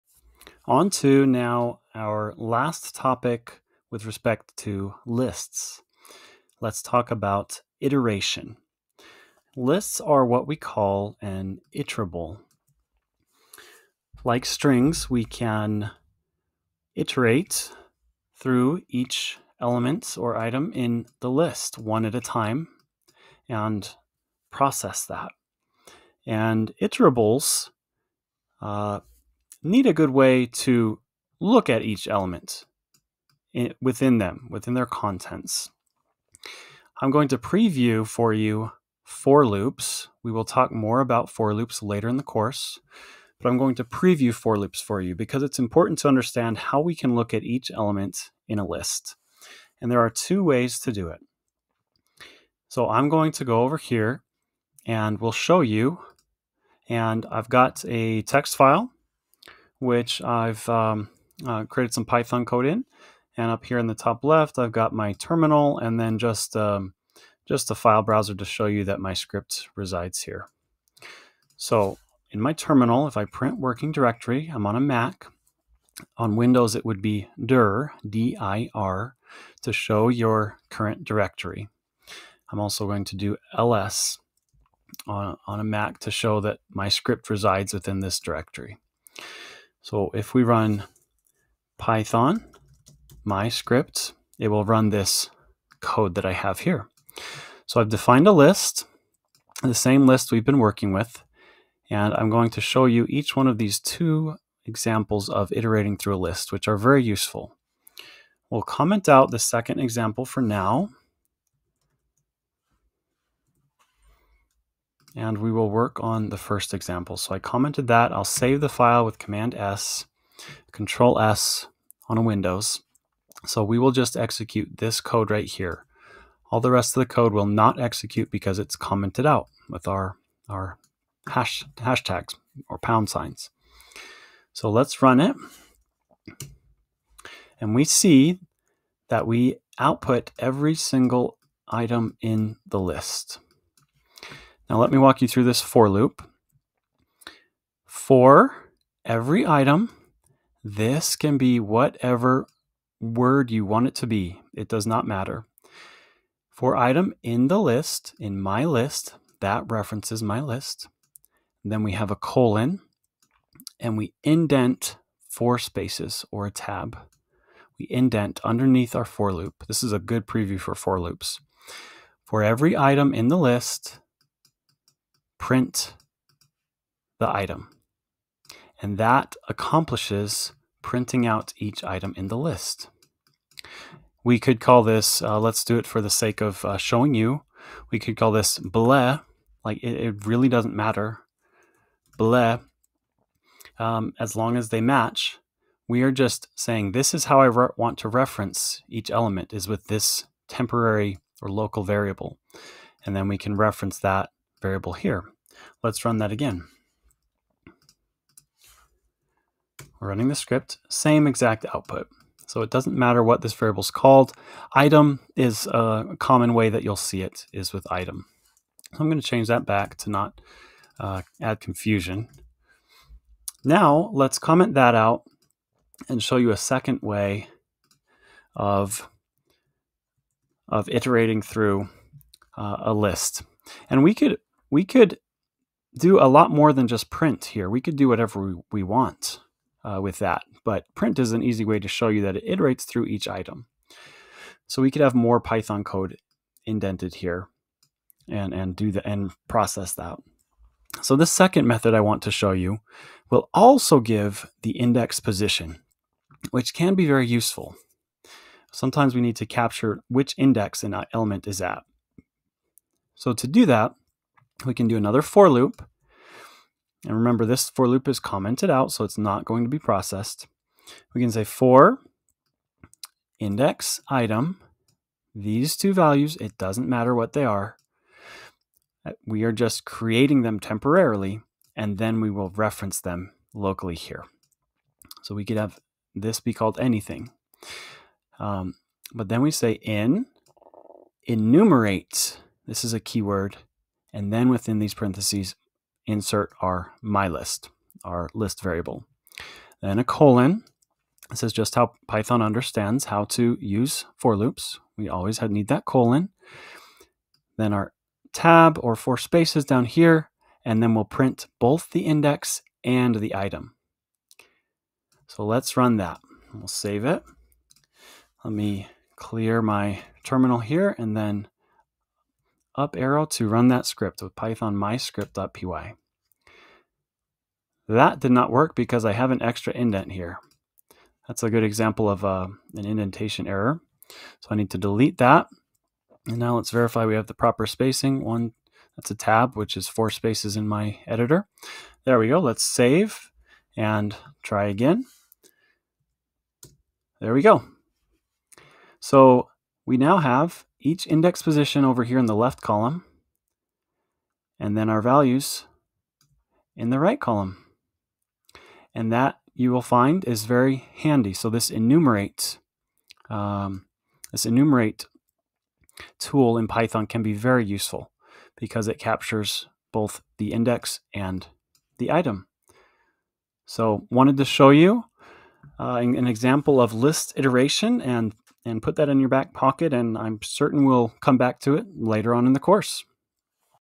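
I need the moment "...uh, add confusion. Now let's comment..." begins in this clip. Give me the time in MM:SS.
03:40.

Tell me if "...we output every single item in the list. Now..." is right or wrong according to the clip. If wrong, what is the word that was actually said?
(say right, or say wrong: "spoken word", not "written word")
right.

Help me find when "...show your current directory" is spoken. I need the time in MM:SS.
01:19.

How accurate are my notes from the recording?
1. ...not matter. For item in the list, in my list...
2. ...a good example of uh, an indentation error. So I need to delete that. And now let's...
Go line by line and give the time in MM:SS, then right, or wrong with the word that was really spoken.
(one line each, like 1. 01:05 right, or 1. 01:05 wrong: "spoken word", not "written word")
1. 02:34 right
2. 05:31 right.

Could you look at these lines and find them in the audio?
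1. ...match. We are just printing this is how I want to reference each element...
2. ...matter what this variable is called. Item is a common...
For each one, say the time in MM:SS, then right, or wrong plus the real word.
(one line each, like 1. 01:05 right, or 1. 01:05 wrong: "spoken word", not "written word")
1. 03:14 wrong: "saying", not "printing"
2. 03:32 right.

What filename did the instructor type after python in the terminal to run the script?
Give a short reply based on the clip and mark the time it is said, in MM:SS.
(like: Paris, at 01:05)
myscript.py, at 05:24.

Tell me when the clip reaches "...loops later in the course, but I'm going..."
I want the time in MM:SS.
00:41.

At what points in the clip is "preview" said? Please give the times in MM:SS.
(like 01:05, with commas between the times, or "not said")
00:37, 00:43, 02:50.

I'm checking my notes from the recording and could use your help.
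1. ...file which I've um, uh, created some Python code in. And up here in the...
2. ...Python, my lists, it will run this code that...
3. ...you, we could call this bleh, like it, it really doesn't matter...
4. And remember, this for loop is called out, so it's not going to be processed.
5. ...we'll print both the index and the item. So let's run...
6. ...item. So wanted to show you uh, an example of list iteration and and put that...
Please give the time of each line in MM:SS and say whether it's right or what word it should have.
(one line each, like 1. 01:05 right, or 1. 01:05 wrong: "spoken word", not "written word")
1. 00:58 right
2. 01:31 wrong: "scripts", not "lists"
3. 03:07 right
4. 04:27 wrong: "commented", not "called"
5. 05:10 right
6. 06:12 right.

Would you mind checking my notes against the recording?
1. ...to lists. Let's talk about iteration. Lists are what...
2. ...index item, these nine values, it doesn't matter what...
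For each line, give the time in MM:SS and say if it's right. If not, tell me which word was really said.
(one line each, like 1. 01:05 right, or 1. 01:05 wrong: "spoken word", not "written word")
1. 00:04 right
2. 04:33 wrong: "two", not "nine".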